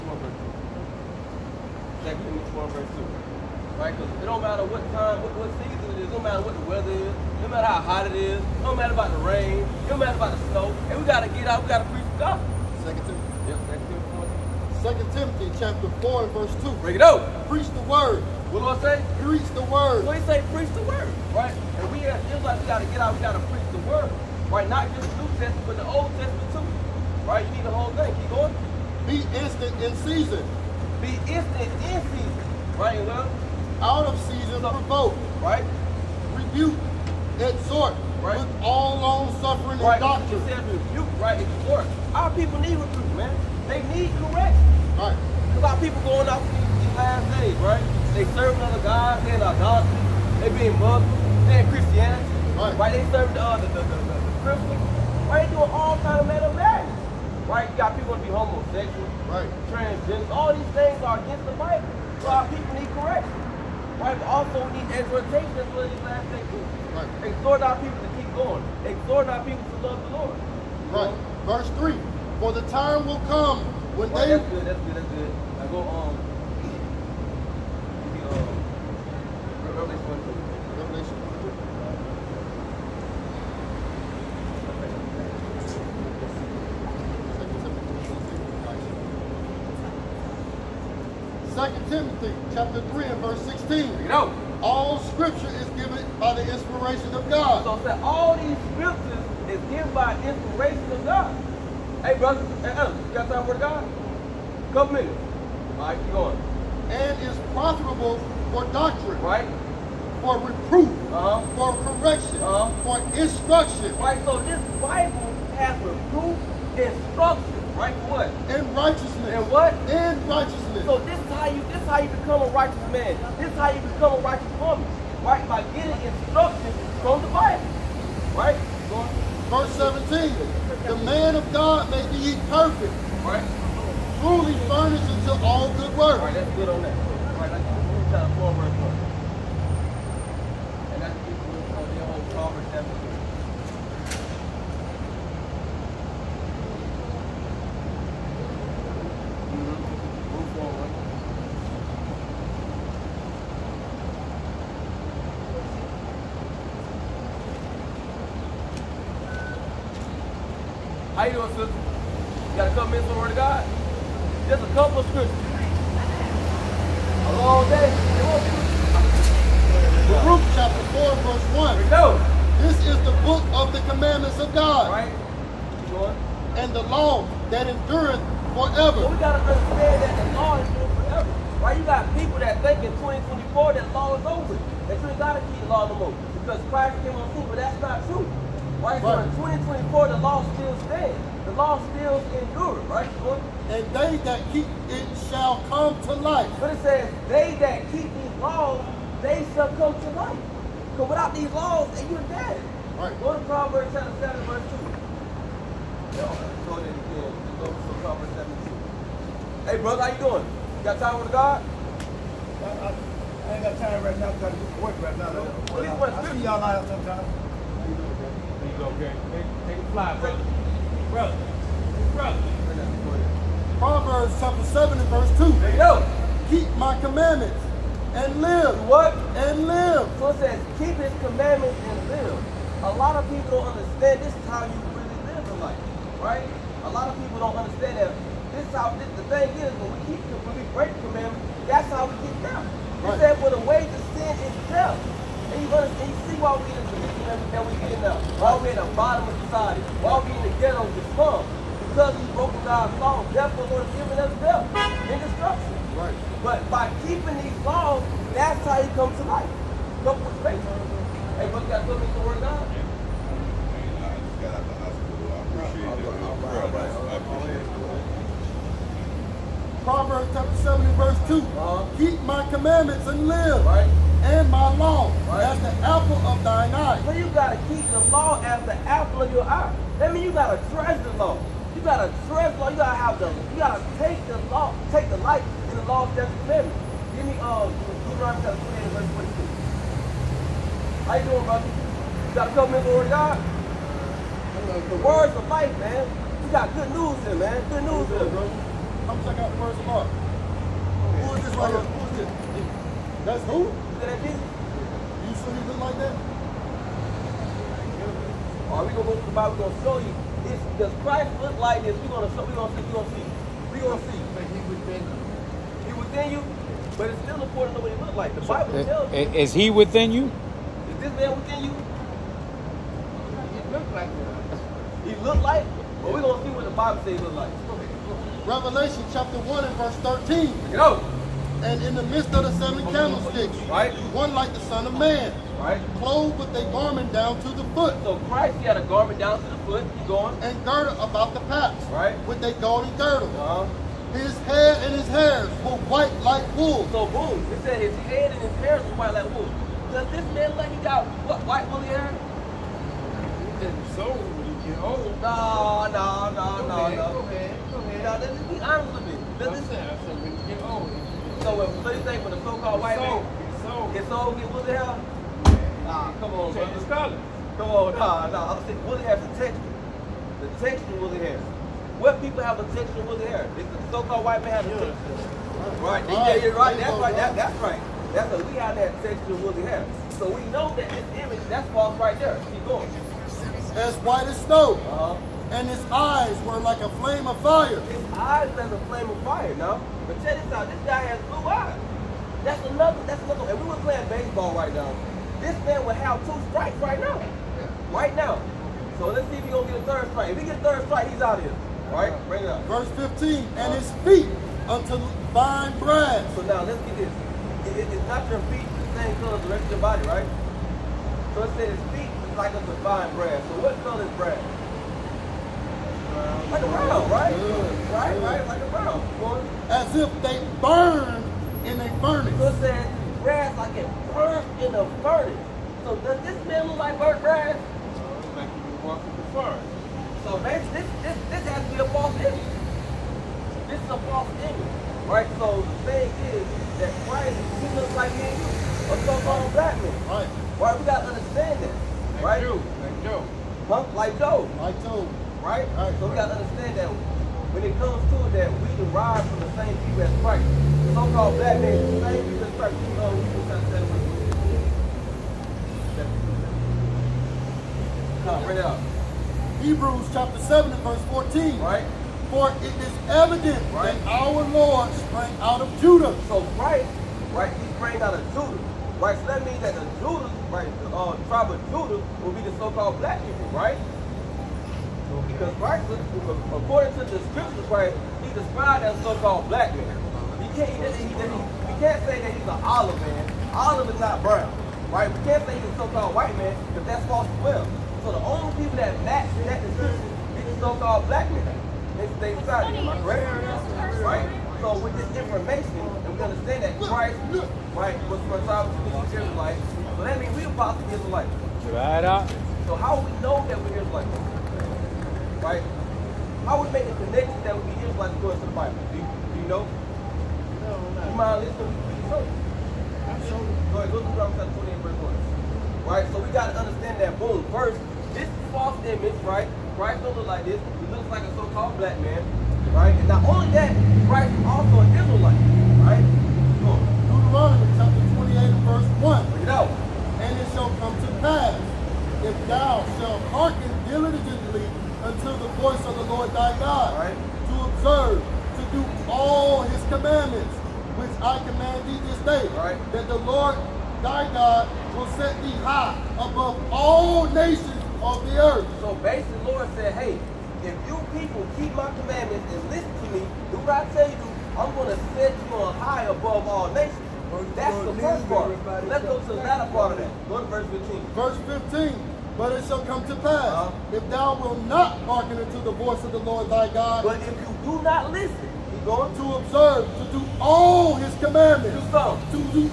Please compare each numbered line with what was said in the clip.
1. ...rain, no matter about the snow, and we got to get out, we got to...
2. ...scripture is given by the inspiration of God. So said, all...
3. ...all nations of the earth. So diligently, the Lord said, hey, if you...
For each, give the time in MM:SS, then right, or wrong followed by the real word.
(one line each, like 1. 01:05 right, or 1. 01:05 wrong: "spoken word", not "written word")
1. 00:09 right
2. 01:35 right
3. 09:06 wrong: "basically", not "diligently".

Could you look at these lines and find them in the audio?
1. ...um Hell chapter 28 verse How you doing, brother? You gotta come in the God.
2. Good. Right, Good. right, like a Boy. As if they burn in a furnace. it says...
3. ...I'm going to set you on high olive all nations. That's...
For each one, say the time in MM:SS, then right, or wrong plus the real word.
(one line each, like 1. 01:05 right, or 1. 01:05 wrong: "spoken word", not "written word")
1. 04:47 wrong: "Deuteronomy", not "Hell"
2. 06:57 right
3. 09:14 wrong: "above", not "olive".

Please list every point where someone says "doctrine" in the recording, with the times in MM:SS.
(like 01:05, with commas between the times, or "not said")
00:40, 01:48.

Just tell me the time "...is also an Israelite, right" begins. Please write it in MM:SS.
08:44.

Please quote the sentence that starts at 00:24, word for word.
Not just the New Testament, but the Old Testament too, right?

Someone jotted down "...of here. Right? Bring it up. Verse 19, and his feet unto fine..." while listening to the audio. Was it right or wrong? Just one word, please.
wrong.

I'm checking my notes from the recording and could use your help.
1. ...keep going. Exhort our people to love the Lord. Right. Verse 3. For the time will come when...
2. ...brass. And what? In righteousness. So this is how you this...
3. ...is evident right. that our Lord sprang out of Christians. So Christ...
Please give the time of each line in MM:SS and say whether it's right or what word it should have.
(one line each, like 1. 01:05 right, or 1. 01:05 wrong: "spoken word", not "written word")
1. 01:08 right
2. 01:58 wrong: "righteousness", not "brass"
3. 07:42 wrong: "Judah", not "Christians".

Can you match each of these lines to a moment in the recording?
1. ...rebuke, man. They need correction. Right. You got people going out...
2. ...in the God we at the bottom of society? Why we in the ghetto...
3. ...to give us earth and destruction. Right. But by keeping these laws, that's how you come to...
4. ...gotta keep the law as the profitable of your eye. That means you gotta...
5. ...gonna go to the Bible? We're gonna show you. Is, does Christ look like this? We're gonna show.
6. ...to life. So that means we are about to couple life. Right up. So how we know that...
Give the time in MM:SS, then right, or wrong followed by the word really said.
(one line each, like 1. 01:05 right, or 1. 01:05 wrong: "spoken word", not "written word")
1. 00:42 right
2. 04:07 wrong: "Why", not "God"
3. 04:13 wrong: "death", not "earth"
4. 04:37 wrong: "apple", not "profitable"
5. 05:08 right
6. 08:19 wrong: "apostle", not "couple".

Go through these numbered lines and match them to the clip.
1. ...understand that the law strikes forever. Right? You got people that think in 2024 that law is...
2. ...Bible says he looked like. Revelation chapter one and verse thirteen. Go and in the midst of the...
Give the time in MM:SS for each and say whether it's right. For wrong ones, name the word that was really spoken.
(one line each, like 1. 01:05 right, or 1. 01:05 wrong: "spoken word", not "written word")
1. 02:59 wrong: "endures", not "strikes"
2. 05:26 right.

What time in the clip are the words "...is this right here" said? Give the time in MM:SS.
05:01.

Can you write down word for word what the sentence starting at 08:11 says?
They, they decided, am I correct?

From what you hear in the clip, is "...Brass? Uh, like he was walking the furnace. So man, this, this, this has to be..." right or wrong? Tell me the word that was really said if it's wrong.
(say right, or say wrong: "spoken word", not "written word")
right.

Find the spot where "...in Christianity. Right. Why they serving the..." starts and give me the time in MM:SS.
00:51.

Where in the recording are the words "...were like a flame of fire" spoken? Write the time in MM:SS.
06:26.